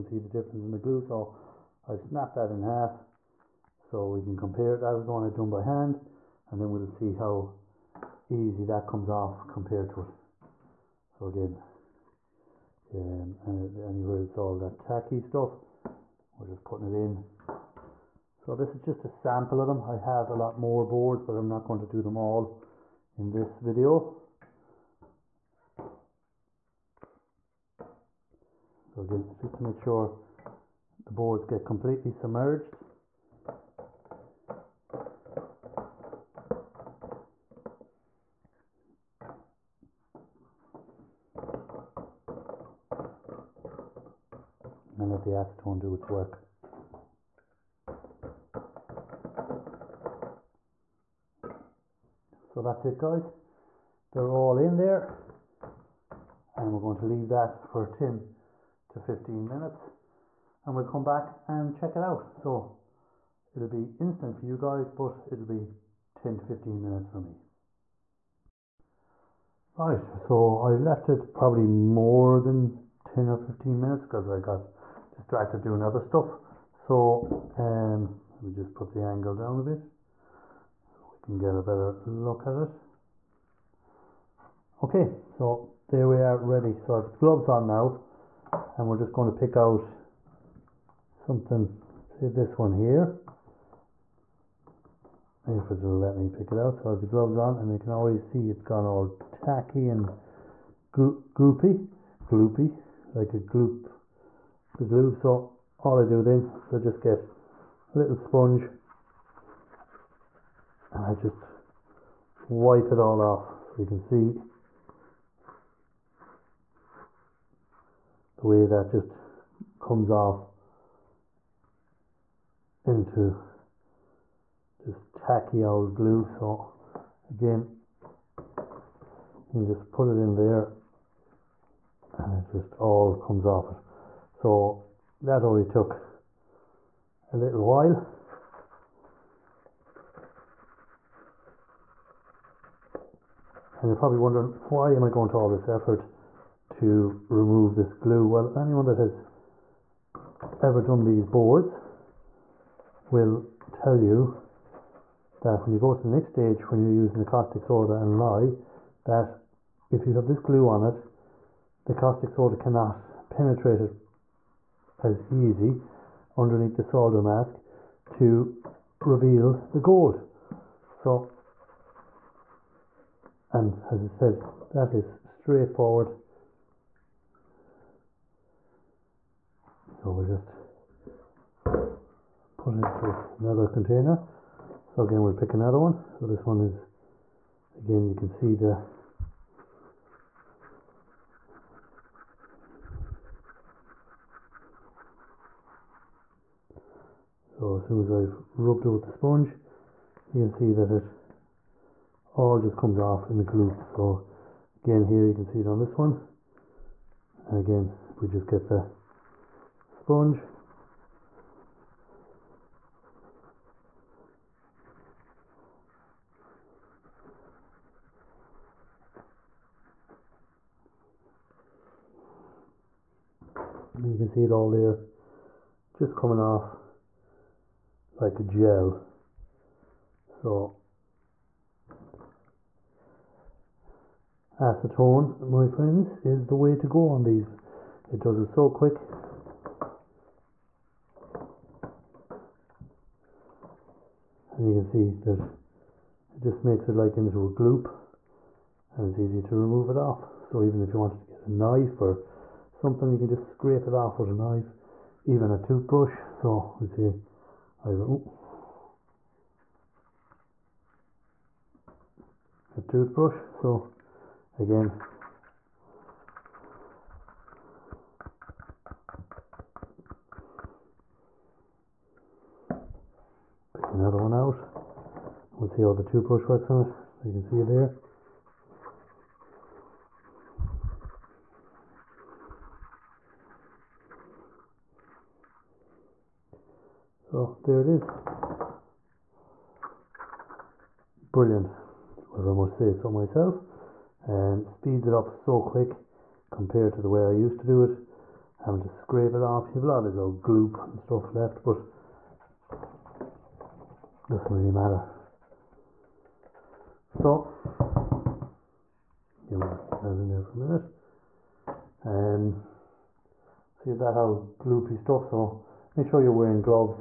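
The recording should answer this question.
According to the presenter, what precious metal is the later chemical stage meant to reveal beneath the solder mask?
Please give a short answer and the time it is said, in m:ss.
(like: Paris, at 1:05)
gold, at 2:49.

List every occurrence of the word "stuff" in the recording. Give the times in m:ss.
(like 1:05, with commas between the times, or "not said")
0:15, 1:15, 5:00, 5:14.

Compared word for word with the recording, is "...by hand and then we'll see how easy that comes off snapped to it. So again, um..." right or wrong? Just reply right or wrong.
wrong.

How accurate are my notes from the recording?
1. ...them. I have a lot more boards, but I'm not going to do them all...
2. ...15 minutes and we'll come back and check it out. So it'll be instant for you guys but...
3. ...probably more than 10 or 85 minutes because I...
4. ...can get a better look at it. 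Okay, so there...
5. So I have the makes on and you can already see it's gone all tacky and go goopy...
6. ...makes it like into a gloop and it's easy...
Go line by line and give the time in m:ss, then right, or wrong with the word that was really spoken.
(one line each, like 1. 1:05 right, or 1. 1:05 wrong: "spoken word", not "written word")
1. 0:19 right
2. 0:58 right
3. 1:11 wrong: "15", not "85"
4. 1:21 right
5. 1:36 wrong: "gloves", not "makes"
6. 4:06 right.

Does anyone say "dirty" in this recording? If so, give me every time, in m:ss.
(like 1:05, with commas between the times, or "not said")
not said.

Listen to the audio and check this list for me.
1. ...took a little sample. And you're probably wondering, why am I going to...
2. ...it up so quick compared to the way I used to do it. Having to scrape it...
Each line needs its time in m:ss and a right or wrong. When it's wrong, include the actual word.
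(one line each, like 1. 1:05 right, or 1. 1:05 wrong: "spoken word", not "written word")
1. 2:15 wrong: "while", not "sample"
2. 4:55 right.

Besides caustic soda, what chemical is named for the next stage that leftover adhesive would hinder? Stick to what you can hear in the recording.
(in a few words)
lye.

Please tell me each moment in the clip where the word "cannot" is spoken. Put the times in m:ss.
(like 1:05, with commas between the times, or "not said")
2:42.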